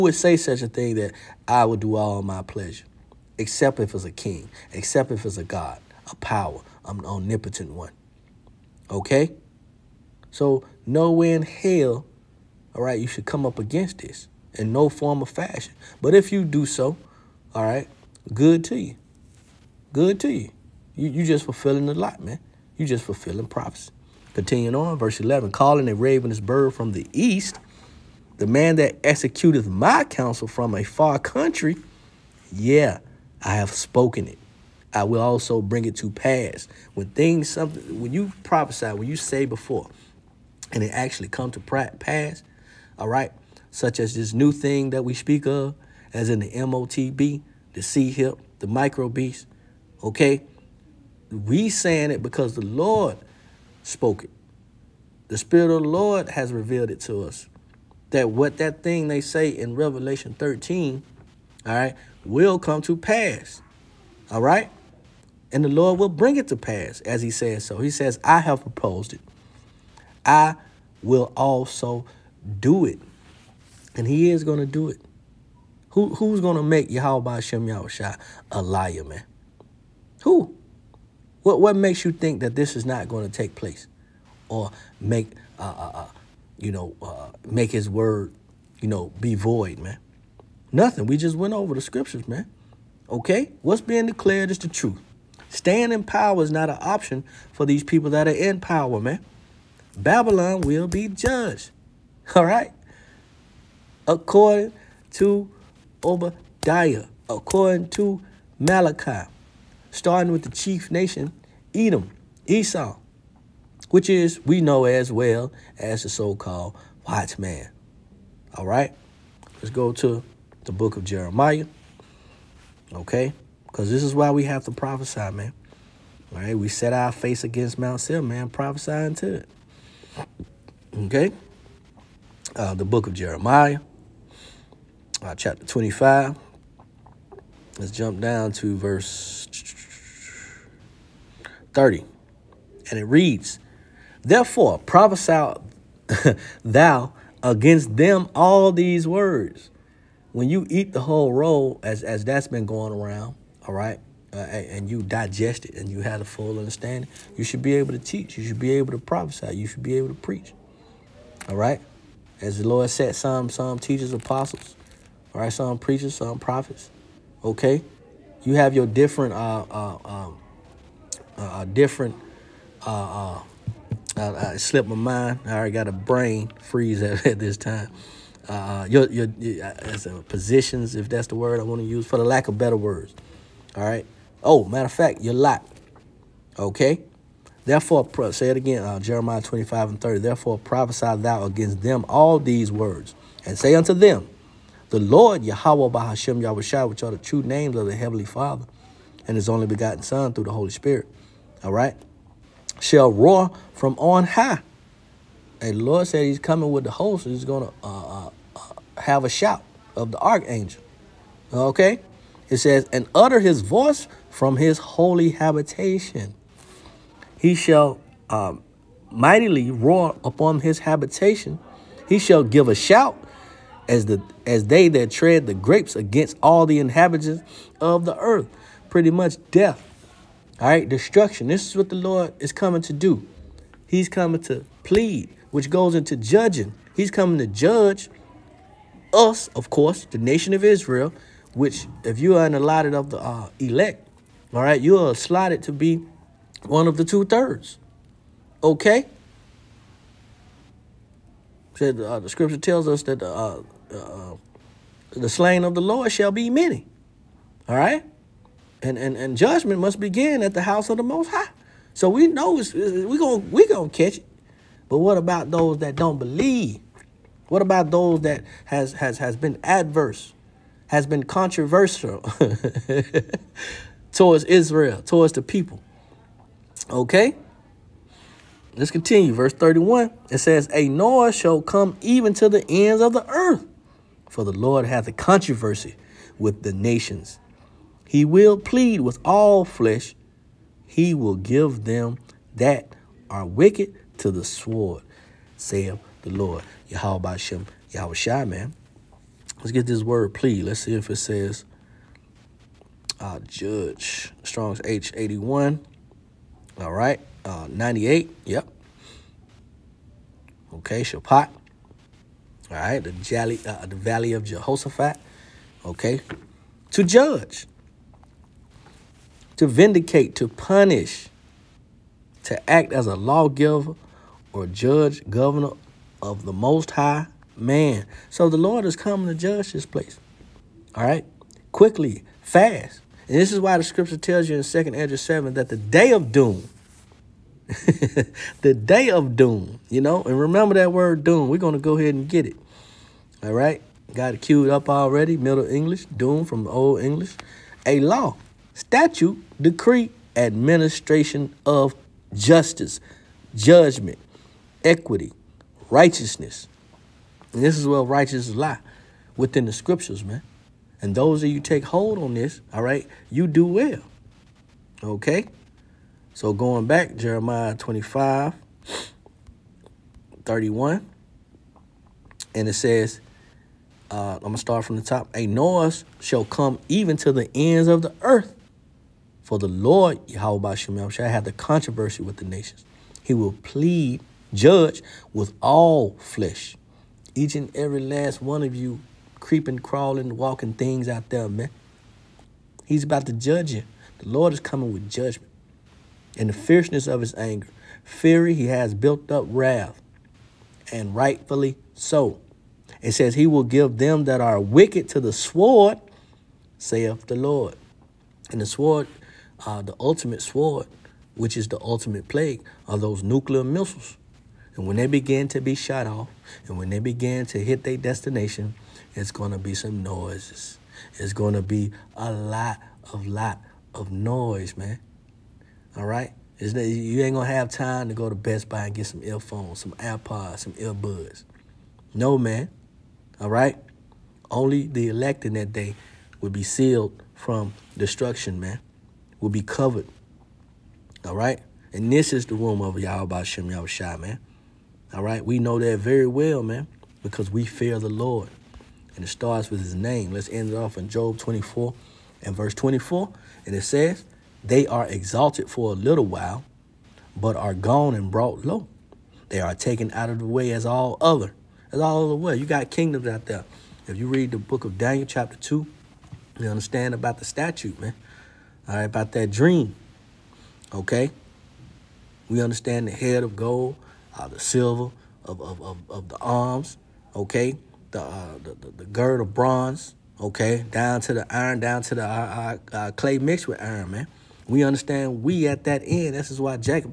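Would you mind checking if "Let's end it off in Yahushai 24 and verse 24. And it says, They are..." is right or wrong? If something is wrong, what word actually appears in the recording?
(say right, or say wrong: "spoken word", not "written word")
wrong: "Job", not "Yahushai".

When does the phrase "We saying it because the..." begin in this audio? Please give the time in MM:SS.
00:51.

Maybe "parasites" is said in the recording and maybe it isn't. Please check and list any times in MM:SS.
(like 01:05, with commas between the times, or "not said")
not said.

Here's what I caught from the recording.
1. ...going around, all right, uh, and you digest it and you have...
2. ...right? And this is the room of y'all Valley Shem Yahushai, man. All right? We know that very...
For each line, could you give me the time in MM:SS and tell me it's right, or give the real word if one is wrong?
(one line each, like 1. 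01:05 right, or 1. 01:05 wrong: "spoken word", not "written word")
1. 02:32 right
2. 07:21 wrong: "Yahweh", not "Valley".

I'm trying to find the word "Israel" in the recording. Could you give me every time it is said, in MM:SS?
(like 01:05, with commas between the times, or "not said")
04:00, 04:34.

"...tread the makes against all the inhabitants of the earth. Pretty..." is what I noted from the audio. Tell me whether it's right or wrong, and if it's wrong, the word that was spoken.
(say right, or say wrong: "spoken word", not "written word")
wrong: "grapes", not "makes".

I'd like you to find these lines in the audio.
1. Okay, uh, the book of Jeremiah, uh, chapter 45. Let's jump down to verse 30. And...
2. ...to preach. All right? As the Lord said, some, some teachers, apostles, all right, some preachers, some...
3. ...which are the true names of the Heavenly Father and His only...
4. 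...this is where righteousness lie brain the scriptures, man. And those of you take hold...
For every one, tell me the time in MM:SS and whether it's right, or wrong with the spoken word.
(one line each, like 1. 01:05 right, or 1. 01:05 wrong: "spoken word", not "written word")
1. 02:10 wrong: "25", not "45"
2. 02:40 right
3. 03:16 right
4. 05:57 wrong: "within", not "brain".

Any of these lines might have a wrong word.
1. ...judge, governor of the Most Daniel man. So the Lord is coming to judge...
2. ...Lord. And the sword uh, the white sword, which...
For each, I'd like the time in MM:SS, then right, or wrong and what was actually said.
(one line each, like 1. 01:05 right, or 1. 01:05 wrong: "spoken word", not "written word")
1. 05:24 wrong: "High", not "Daniel"
2. 06:47 wrong: "ultimate", not "white".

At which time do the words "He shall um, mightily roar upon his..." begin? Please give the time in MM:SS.
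03:37.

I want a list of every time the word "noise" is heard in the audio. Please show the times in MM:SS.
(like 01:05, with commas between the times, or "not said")
04:40, 06:15, 07:00, 07:04.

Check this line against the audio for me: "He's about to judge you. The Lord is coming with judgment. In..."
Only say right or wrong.
right.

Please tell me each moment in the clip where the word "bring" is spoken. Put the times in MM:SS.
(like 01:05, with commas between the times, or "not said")
00:35, 01:06.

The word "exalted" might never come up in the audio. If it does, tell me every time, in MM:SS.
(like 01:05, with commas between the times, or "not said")
07:35.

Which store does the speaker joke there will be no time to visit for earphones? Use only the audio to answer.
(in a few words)
Best Buy.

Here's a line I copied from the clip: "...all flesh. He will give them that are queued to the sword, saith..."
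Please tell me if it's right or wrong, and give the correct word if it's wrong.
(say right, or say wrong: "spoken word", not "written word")
wrong: "wicked", not "queued".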